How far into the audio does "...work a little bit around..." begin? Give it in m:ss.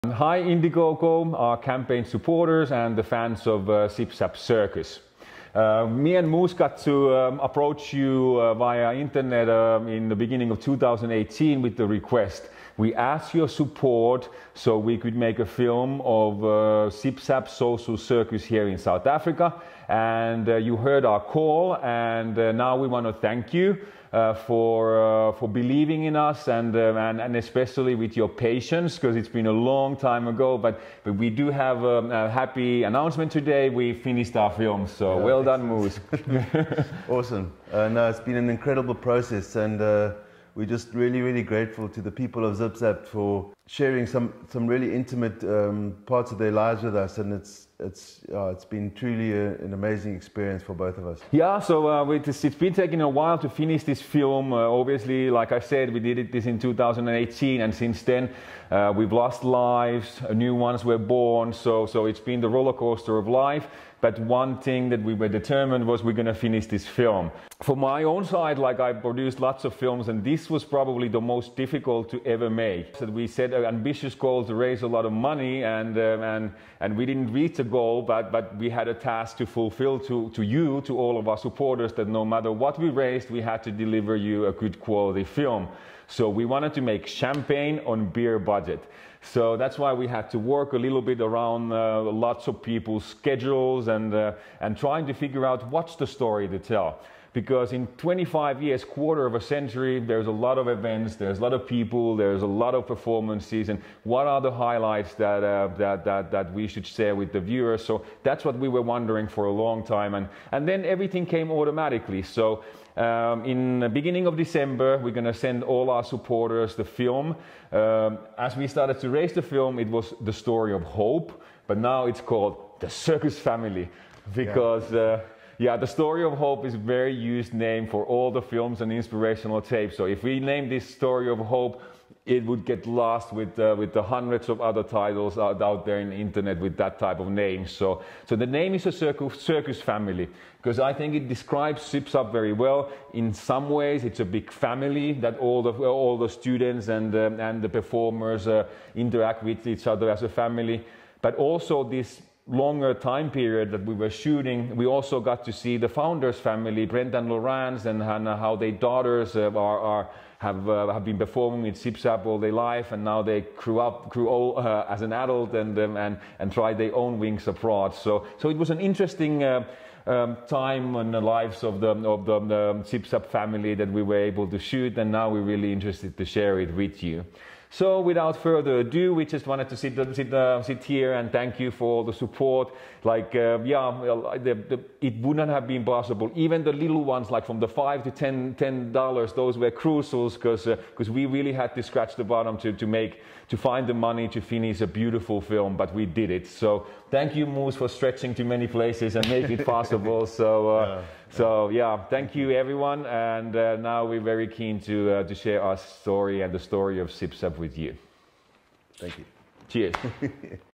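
1:30.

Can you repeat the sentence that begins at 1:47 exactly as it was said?
So that's what we were wondering for a long time, and, and then everything came automatically.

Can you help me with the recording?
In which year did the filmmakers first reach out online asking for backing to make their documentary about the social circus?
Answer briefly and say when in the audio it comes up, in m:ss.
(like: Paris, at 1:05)
2018, at 0:10.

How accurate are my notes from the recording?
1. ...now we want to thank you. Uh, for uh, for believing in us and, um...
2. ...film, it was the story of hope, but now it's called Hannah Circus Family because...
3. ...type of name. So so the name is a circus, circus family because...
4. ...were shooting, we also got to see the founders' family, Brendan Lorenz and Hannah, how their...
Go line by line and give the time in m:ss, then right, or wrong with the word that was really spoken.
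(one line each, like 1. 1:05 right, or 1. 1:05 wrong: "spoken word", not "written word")
1. 0:22 right
2. 1:59 wrong: "The", not "Hannah"
3. 2:16 right
4. 2:33 right.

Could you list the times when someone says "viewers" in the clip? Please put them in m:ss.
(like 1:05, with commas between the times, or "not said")
1:47.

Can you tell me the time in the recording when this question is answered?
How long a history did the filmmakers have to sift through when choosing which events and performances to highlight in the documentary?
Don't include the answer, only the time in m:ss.
1:37.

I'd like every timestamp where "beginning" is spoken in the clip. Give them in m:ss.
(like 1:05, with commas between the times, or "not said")
0:10, 1:53.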